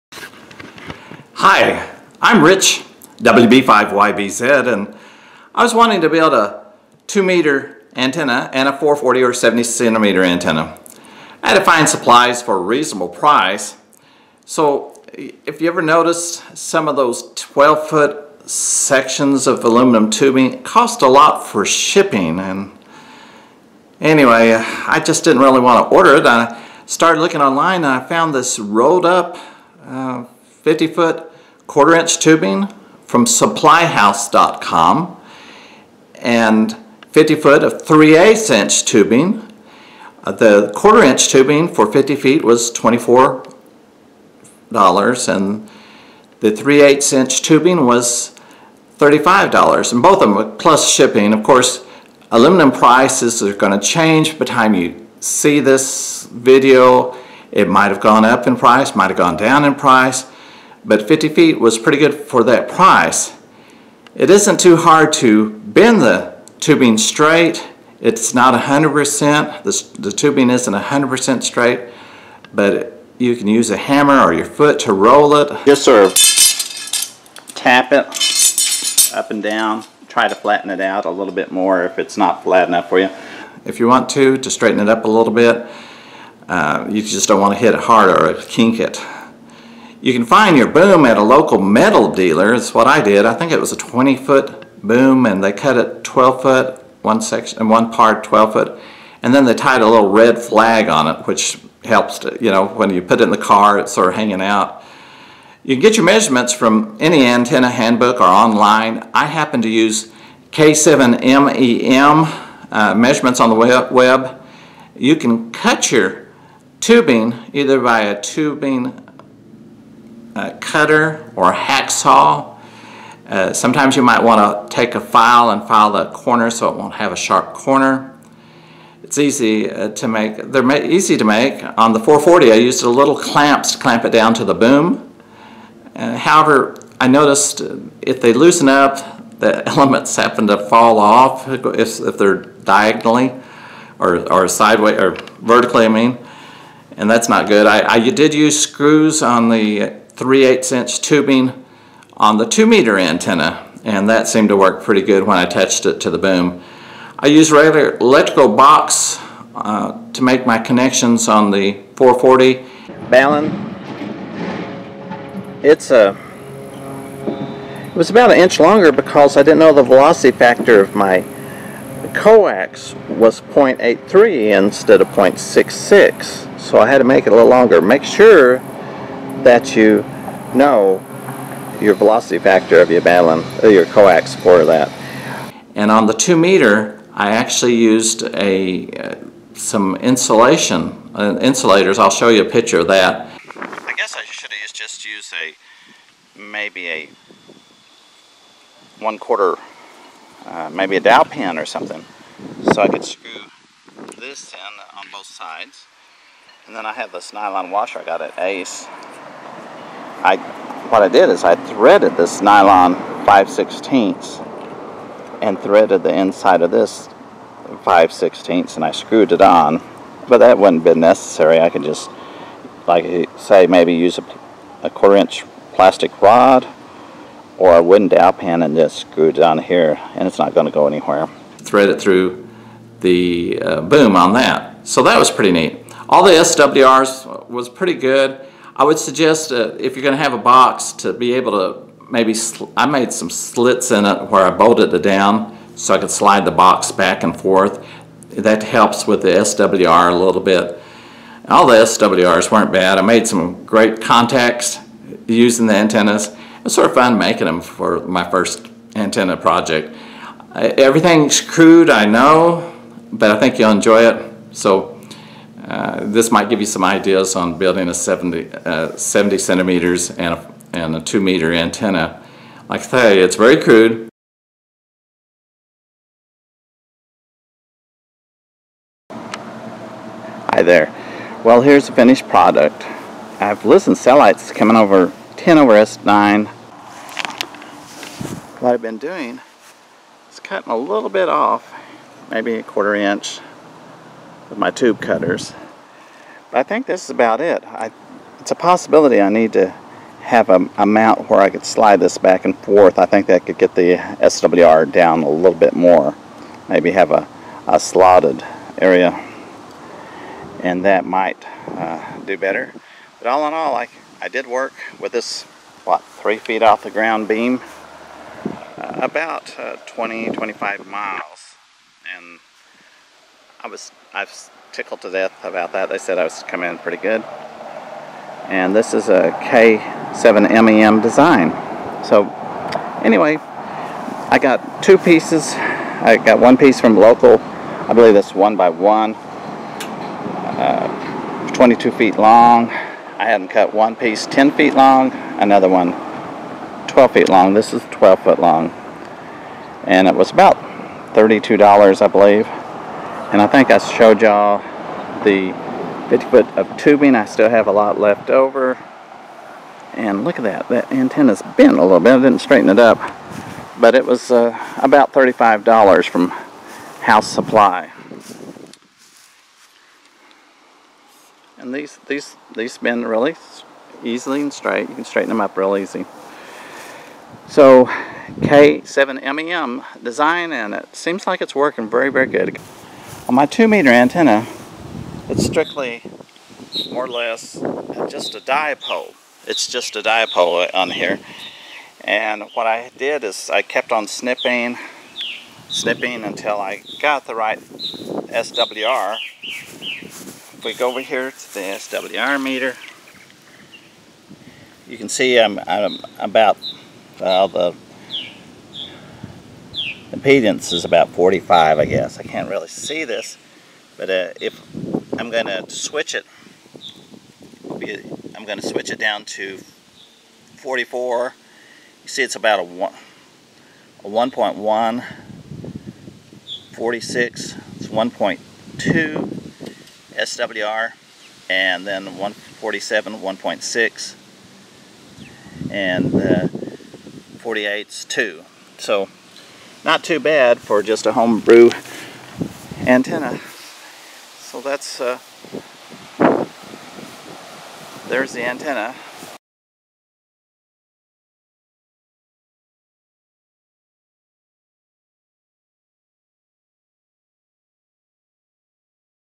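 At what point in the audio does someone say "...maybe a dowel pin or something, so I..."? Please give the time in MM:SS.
03:20.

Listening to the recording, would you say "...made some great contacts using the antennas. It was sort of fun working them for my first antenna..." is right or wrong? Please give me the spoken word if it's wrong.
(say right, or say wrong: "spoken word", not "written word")
wrong: "making", not "working".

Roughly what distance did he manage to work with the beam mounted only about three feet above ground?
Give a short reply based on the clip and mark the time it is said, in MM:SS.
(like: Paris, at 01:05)
20 to 25 miles, at 05:19.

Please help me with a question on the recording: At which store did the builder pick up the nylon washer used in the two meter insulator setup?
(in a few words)
Ace.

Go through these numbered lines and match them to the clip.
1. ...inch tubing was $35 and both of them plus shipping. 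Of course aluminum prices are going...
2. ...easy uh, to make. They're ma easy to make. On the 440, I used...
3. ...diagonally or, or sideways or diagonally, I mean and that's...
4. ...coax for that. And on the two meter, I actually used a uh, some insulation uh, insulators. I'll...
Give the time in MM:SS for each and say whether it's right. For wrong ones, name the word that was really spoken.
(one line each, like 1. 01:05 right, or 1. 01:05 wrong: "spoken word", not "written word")
1. 00:47 right
2. 02:09 right
3. 02:22 wrong: "vertically", not "diagonally"
4. 03:03 right.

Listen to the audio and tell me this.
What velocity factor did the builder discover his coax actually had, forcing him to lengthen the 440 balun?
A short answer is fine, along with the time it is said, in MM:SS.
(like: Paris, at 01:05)
0.83, at 02:53.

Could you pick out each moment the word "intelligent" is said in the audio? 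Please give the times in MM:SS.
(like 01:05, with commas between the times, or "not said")
not said.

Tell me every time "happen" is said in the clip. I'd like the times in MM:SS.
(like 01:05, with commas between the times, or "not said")
01:49, 02:20.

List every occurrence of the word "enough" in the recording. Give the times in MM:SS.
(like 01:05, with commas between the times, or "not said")
01:22.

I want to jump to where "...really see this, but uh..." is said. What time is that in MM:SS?
06:52.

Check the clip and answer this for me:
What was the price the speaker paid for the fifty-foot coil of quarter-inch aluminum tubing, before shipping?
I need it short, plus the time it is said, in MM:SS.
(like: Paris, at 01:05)
$24, at 00:42.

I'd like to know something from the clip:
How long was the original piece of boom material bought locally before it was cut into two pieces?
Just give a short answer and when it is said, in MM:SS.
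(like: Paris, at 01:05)
22 feet, at 05:41.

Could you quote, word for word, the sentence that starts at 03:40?
But that wouldn't have been necessary.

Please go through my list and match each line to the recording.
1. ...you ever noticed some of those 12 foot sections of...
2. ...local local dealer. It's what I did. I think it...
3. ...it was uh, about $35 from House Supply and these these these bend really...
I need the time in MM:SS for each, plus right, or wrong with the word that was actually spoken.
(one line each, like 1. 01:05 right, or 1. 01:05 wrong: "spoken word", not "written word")
1. 00:15 right
2. 01:31 wrong: "metal", not "local"
3. 06:03 right.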